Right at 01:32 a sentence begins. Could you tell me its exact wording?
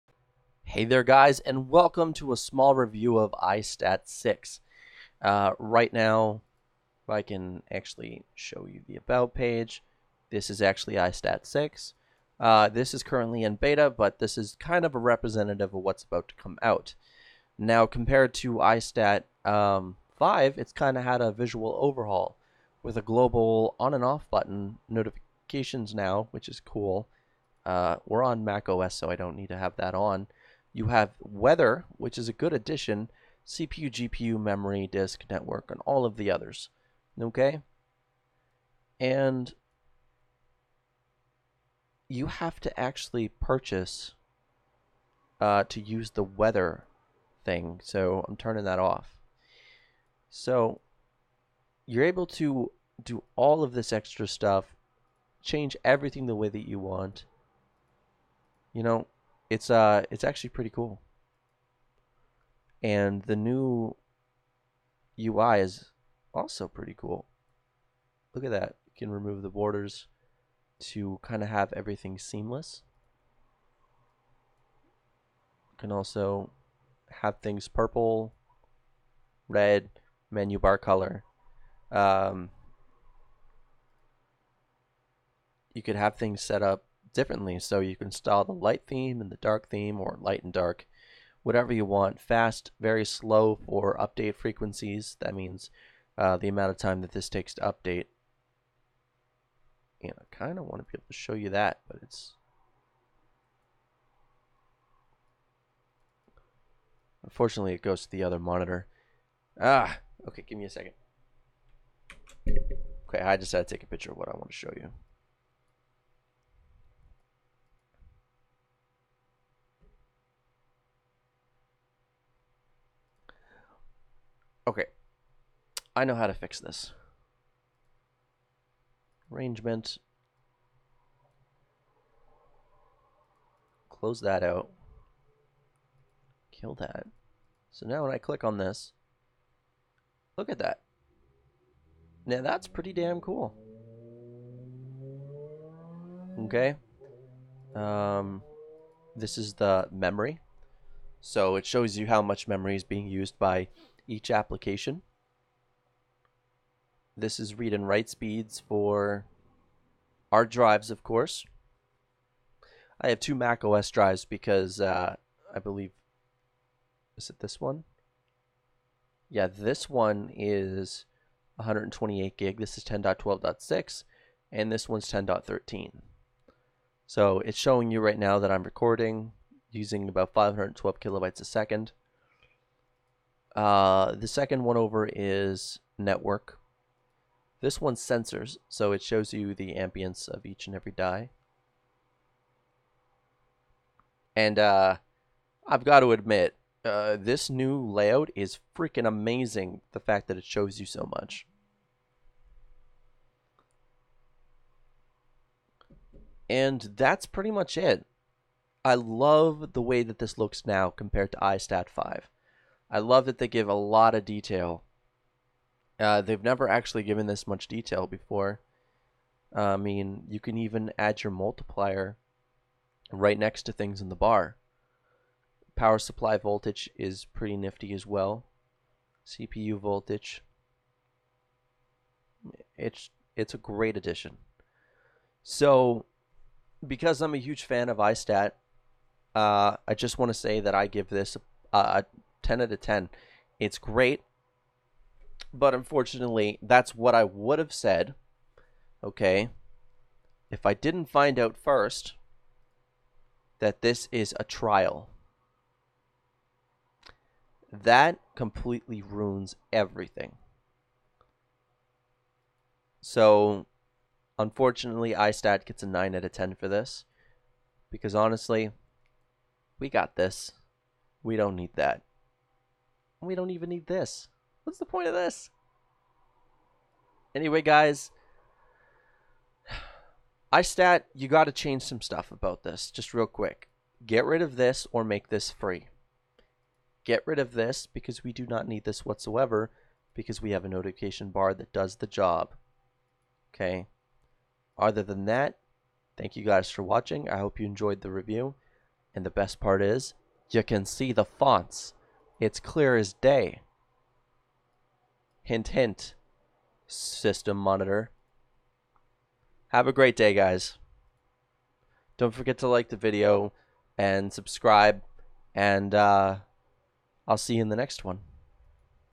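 Fast, very slow for update frequencies.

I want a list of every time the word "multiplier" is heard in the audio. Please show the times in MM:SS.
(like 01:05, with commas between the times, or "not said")
03:41.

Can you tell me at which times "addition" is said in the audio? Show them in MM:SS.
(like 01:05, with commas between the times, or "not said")
00:32, 03:53.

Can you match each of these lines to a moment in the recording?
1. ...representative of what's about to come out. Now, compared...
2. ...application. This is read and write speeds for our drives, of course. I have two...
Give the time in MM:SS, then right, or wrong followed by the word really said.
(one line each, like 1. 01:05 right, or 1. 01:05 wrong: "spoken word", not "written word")
1. 00:14 right
2. 02:34 right.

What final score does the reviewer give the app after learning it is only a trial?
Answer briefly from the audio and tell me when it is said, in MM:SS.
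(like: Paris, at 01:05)
9 out of 10, at 04:25.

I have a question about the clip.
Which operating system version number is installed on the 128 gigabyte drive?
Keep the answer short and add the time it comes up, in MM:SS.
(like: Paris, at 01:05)
10.12.6, at 02:52.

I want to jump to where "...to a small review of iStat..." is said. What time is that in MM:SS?
00:02.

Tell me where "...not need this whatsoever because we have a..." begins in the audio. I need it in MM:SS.
04:48.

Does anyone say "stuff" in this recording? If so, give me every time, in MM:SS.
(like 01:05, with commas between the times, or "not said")
00:54, 04:42.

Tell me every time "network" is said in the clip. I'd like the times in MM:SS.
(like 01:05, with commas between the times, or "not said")
00:35, 03:05.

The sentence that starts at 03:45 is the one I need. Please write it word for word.
Power supply voltage is pretty nifty as well.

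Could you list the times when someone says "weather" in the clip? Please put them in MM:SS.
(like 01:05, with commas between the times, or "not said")
00:31, 00:46.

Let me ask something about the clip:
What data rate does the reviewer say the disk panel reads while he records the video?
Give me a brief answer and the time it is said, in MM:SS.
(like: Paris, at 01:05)
512 KB/s, at 03:00.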